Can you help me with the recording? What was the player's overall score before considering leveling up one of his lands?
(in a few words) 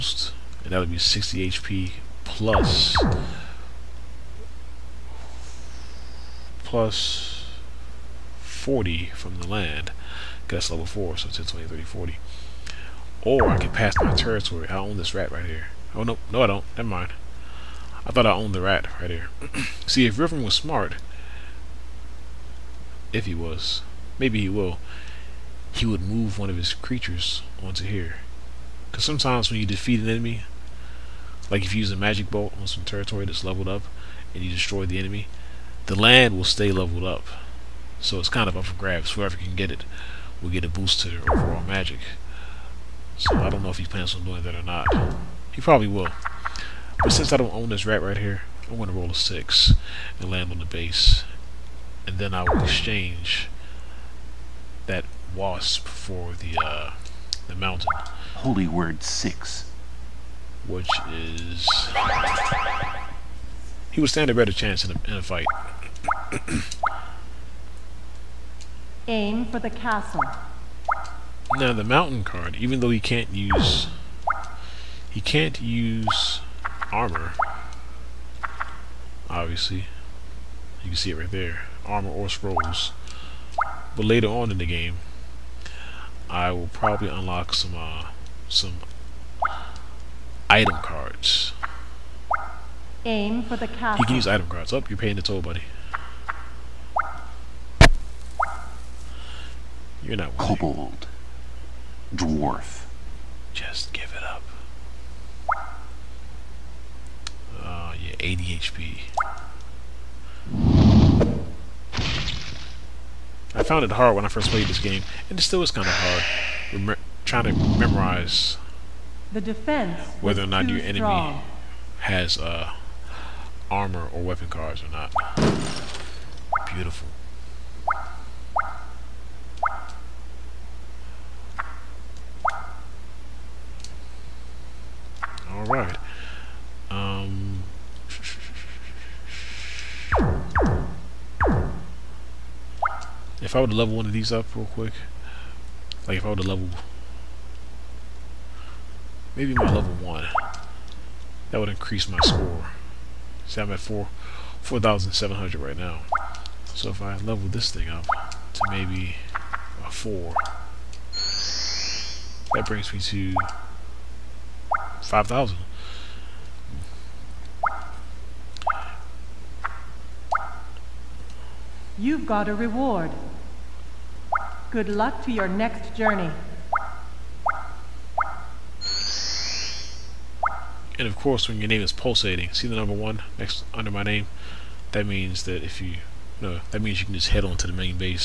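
4,700.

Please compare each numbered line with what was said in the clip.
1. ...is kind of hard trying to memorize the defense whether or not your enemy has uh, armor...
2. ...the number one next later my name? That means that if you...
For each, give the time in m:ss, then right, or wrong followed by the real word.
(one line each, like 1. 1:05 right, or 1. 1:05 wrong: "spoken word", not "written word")
1. 1:55 right
2. 3:02 wrong: "under", not "later".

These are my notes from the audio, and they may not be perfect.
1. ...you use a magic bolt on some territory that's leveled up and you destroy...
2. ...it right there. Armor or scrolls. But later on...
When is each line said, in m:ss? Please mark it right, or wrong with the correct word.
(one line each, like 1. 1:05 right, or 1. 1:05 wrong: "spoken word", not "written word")
1. 0:31 right
2. 1:21 right.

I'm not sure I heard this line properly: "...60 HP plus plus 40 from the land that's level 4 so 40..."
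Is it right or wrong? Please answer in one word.
wrong.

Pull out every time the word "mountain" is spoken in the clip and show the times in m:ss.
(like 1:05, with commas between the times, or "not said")
0:57, 1:11.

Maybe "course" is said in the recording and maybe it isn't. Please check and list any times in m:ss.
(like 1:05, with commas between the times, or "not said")
3:01.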